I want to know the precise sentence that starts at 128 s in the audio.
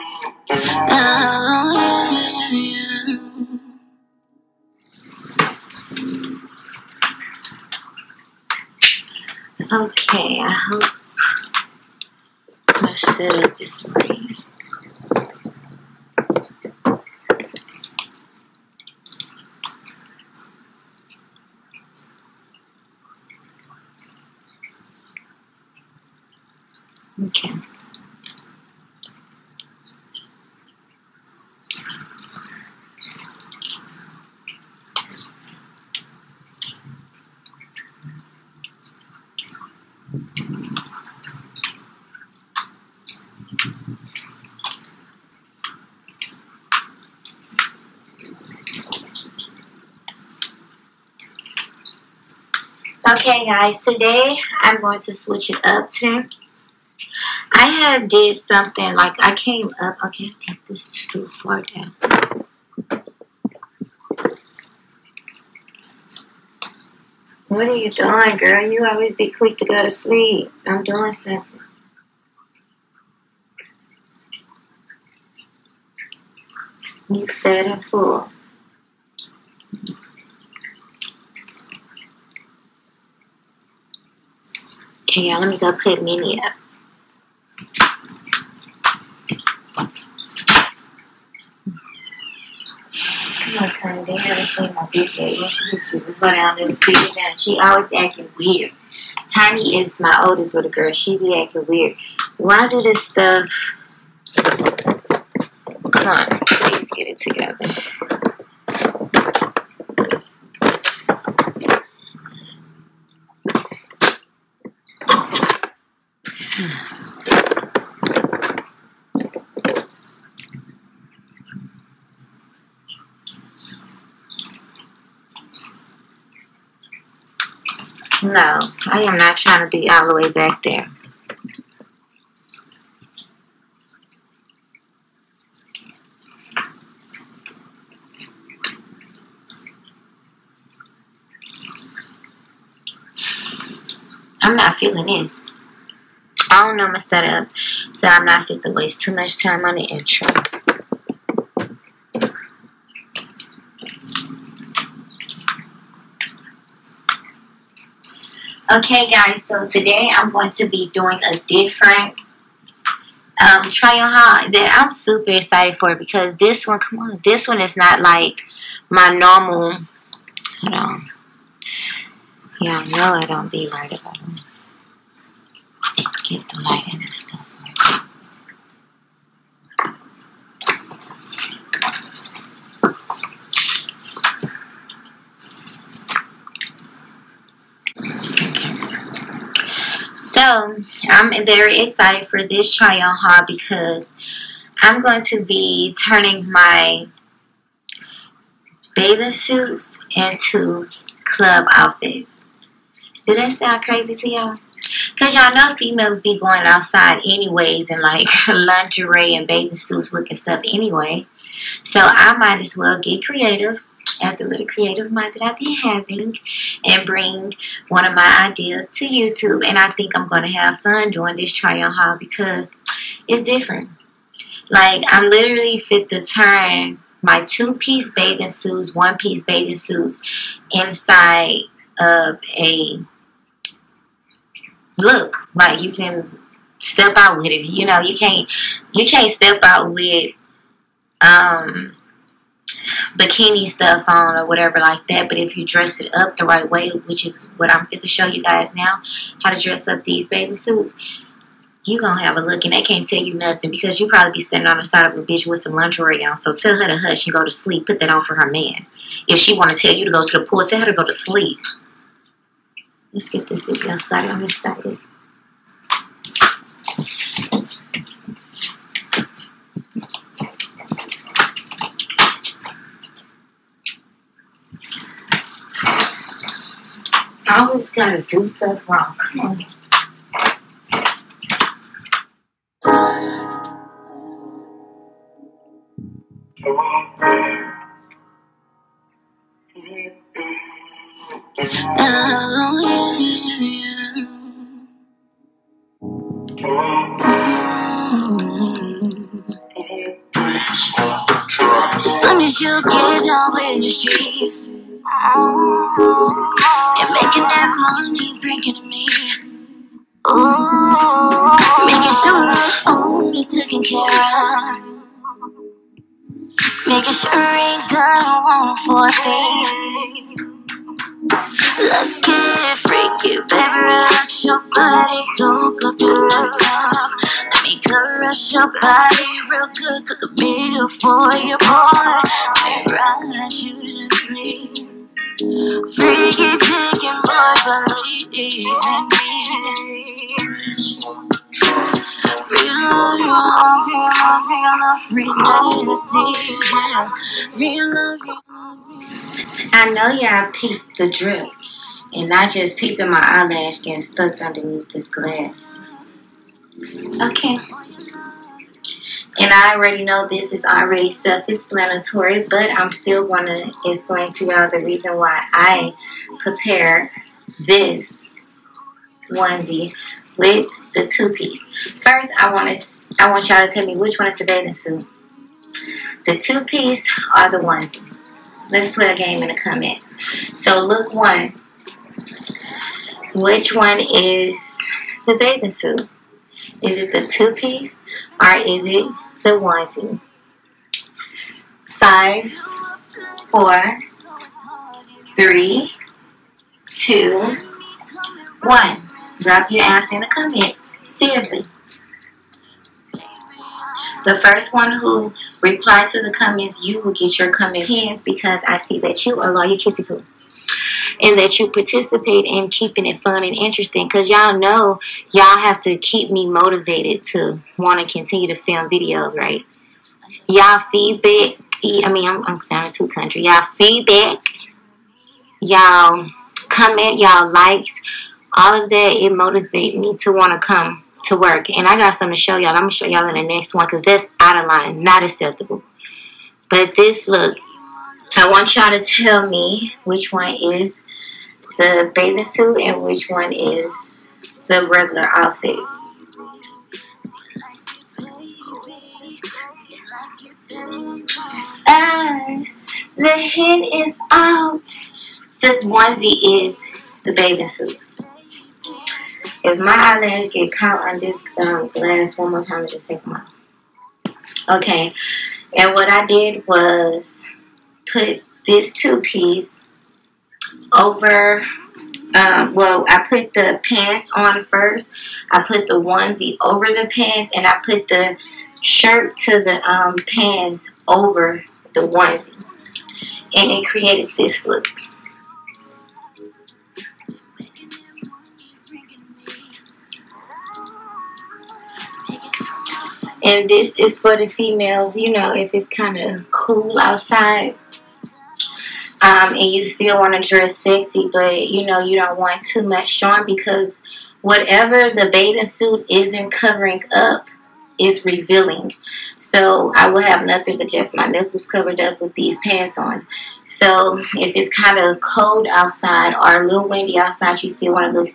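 No, I am not trying to be all the way back there.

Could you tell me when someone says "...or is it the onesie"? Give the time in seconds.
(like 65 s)
388 s.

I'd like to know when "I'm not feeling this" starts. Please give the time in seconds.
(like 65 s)
144 s.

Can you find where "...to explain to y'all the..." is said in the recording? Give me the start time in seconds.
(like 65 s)
363 s.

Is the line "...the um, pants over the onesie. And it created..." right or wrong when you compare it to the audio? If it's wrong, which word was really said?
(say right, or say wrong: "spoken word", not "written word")
right.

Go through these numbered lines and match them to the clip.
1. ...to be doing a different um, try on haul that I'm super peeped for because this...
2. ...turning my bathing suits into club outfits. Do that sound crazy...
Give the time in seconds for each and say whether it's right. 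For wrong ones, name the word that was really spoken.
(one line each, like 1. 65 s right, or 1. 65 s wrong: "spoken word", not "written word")
1. 160 s wrong: "excited", not "peeped"
2. 195 s right.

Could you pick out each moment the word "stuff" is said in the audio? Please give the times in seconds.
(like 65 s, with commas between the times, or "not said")
103 s, 177 s, 210 s, 243 s, 278 s.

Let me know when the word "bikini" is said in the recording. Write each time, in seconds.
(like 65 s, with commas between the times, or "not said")
243 s.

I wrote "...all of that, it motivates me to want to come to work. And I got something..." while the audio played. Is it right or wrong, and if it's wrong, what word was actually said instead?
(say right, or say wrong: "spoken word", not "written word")
right.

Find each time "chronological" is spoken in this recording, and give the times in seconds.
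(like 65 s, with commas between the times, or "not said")
not said.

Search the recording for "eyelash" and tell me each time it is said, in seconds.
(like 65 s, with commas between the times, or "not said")
353 s, 459 s.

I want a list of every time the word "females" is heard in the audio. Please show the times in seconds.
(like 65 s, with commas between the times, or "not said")
205 s, 494 s.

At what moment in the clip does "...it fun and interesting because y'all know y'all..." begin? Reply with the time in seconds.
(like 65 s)
413 s.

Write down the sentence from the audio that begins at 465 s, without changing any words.
And what I did was put this two piece over um, well, I put the pants on first.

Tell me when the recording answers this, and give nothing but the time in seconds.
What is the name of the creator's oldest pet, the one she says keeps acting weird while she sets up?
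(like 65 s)
99 s.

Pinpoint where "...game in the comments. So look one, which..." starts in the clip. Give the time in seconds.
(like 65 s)
379 s.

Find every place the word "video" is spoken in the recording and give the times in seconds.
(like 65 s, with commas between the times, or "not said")
263 s, 418 s.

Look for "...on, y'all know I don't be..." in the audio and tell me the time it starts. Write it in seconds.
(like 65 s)
170 s.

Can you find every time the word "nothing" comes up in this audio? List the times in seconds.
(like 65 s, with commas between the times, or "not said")
253 s, 510 s.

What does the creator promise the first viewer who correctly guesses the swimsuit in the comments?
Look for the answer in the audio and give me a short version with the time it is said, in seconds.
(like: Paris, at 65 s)
comment pinned, at 407 s.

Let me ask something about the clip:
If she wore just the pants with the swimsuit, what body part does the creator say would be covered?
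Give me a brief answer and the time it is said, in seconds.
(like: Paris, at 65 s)
nipples, at 511 s.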